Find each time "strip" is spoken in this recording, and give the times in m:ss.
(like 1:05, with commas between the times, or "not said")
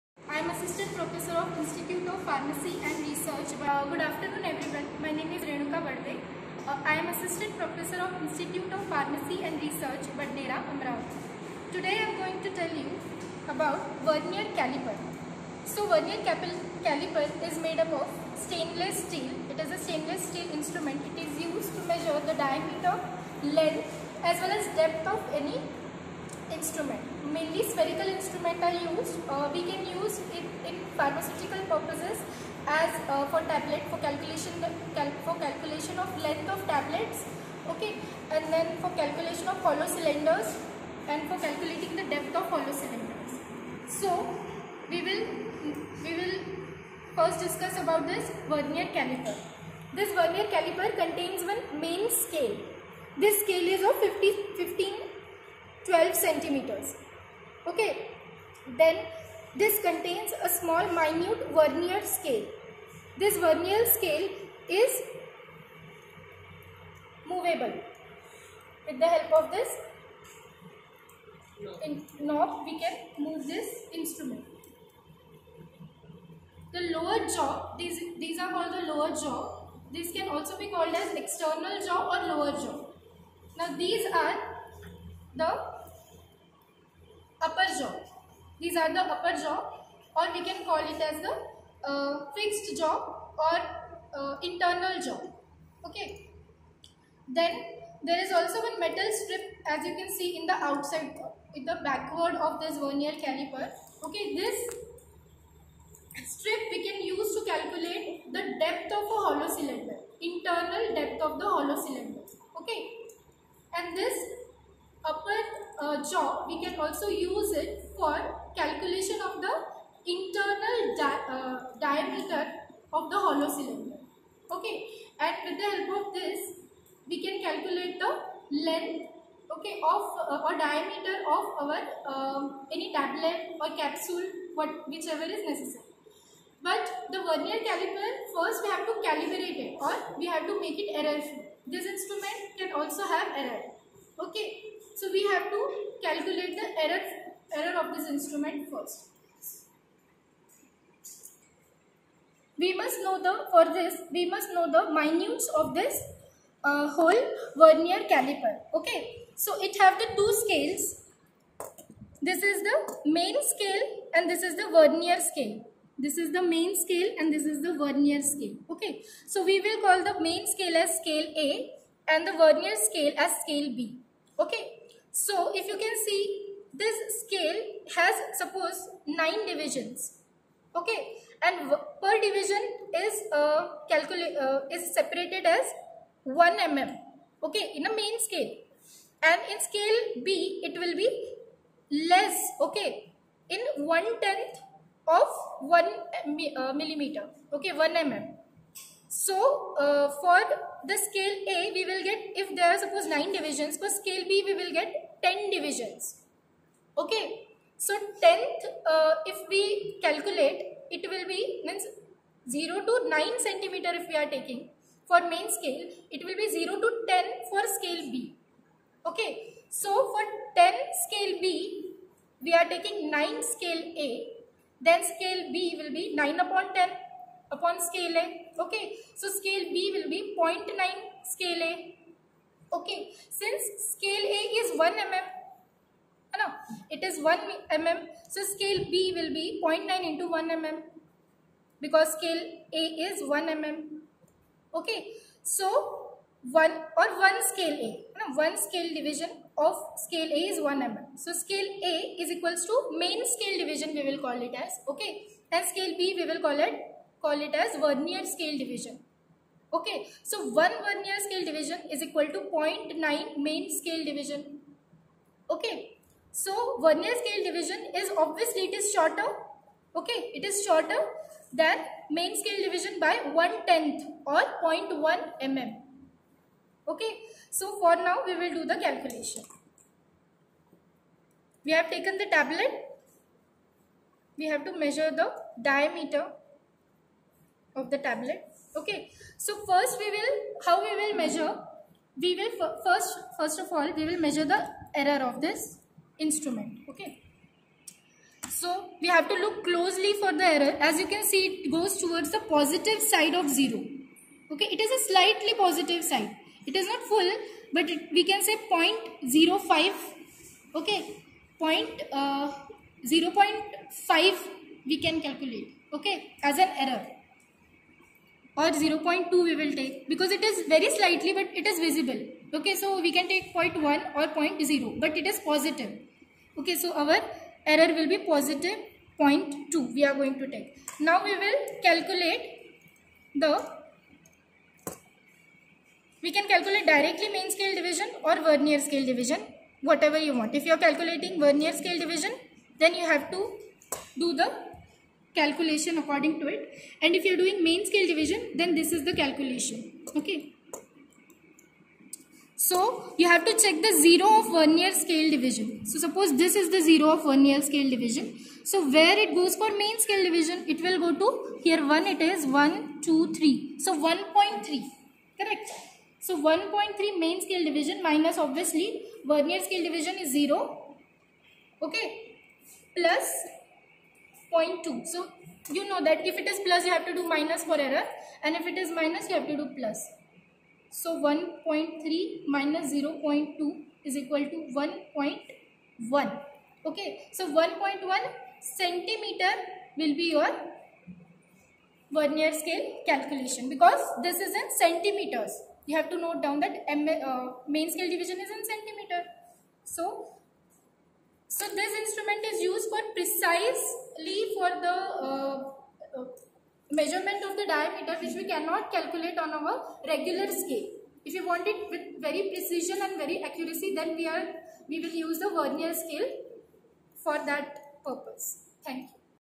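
1:39.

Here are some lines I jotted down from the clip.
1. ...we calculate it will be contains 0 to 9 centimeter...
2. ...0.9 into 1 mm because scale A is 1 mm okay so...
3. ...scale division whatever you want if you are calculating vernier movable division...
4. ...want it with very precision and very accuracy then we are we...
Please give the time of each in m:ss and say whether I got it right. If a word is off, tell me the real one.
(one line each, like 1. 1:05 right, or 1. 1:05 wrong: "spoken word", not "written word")
1. 3:29 wrong: "means", not "contains"
2. 3:59 right
3. 5:38 wrong: "scale", not "movable"
4. 6:51 right.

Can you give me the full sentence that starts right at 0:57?
Okay, then this contains a small minute vernier scale.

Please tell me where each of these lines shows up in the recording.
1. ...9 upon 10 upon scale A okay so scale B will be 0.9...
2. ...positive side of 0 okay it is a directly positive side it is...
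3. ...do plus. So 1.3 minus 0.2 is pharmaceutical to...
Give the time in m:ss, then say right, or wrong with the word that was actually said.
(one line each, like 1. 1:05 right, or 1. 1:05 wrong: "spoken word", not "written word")
1. 3:46 right
2. 5:02 wrong: "slightly", not "directly"
3. 6:19 wrong: "equal", not "pharmaceutical".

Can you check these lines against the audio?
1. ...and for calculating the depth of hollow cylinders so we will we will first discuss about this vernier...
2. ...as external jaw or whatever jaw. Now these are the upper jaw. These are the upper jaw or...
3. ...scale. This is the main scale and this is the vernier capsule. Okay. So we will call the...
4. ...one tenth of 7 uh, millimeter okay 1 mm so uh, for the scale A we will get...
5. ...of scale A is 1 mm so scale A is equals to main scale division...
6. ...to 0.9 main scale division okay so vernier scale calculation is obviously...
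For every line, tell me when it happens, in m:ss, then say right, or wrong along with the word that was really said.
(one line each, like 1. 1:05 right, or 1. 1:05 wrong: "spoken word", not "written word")
1. 0:41 right
2. 1:20 wrong: "lower", not "whatever"
3. 2:45 wrong: "scale", not "capsule"
4. 3:13 wrong: "1", not "7"
5. 4:09 right
6. 4:22 wrong: "division", not "calculation".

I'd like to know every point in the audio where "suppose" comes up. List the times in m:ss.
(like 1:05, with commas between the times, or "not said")
2:58, 3:22, 5:55.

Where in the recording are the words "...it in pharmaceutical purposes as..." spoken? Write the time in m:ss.
0:30.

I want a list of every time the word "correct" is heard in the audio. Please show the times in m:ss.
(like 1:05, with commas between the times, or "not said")
6:05.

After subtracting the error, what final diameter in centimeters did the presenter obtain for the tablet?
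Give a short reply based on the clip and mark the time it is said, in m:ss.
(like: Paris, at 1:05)
1.1 centimeter, at 6:27.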